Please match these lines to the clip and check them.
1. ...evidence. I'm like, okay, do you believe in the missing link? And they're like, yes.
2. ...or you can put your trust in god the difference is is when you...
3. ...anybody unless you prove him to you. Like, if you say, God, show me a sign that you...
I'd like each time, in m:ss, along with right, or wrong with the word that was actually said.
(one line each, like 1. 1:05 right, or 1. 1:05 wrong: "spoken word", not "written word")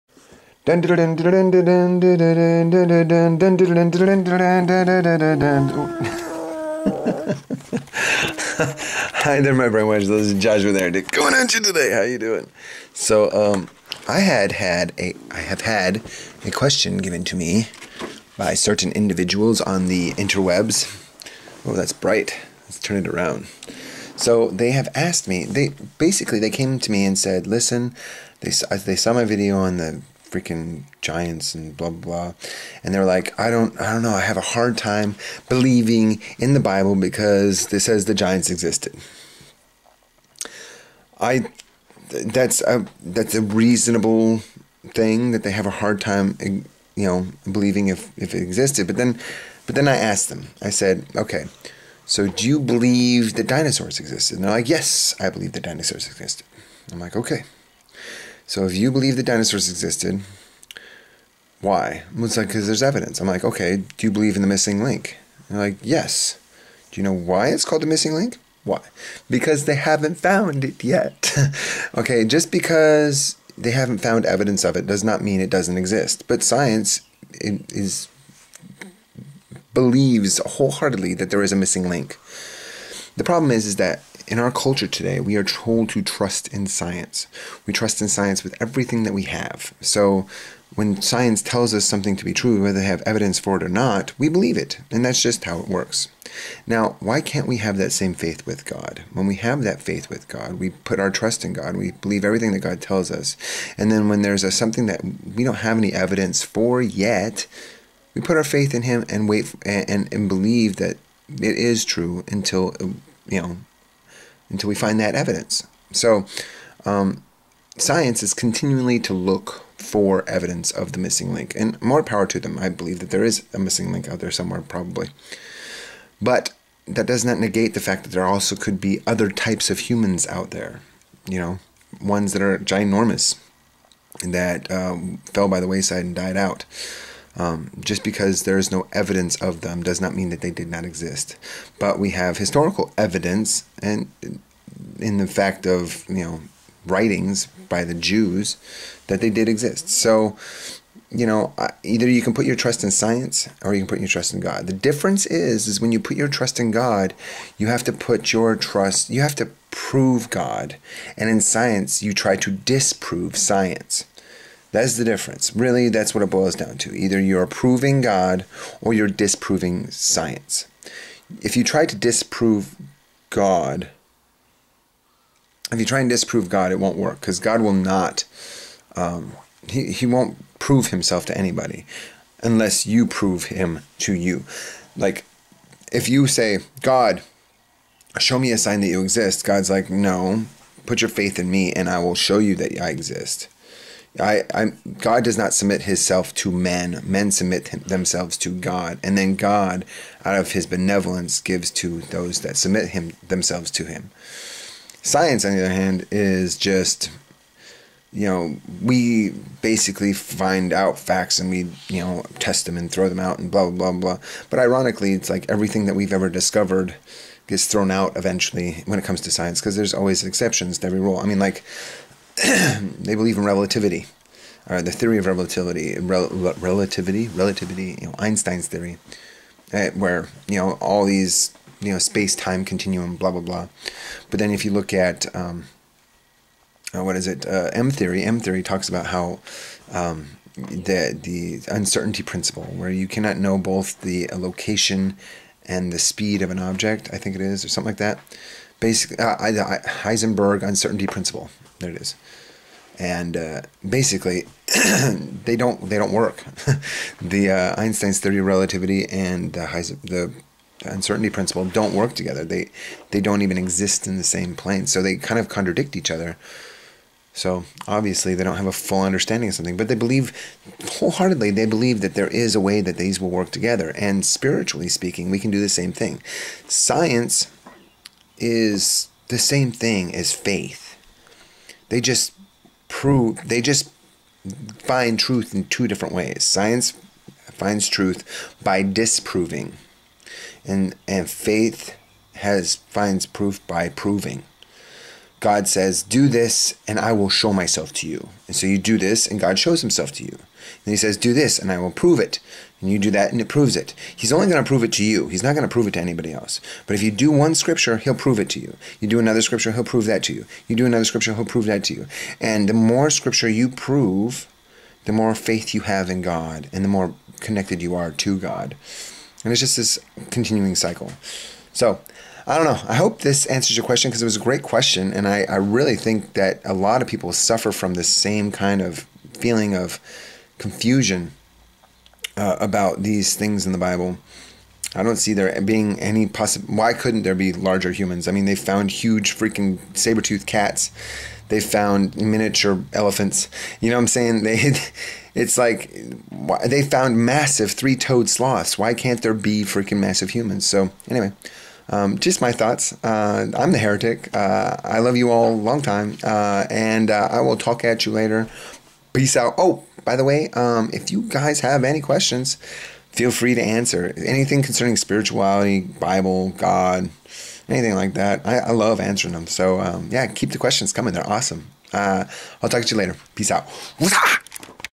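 1. 1:02 right
2. 2:33 right
3. 3:01 right.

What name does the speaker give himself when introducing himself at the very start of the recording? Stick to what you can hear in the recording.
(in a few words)
Joshua.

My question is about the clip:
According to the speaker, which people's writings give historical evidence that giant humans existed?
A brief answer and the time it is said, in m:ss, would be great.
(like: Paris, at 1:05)
the Jews, at 2:27.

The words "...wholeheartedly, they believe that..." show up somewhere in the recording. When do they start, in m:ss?
4:30.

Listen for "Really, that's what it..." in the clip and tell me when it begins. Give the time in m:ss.
2:45.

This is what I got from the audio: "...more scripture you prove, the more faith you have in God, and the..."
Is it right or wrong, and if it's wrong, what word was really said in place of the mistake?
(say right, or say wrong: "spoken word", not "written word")
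right.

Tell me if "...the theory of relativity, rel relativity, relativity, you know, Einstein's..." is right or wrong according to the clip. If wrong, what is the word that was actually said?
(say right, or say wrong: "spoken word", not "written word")
right.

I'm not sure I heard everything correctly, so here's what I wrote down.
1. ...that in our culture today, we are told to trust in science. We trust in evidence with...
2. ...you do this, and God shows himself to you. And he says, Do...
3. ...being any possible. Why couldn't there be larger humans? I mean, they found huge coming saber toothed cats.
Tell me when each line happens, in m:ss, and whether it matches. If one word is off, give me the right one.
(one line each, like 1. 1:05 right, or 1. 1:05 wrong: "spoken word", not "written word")
1. 1:23 wrong: "science", not "evidence"
2. 4:58 right
3. 5:35 wrong: "freaking", not "coming".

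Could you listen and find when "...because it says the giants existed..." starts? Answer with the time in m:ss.
0:36.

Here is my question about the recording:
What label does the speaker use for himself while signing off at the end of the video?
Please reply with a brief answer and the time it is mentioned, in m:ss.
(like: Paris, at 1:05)
the heretic, at 5:53.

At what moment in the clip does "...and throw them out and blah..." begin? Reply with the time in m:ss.
3:32.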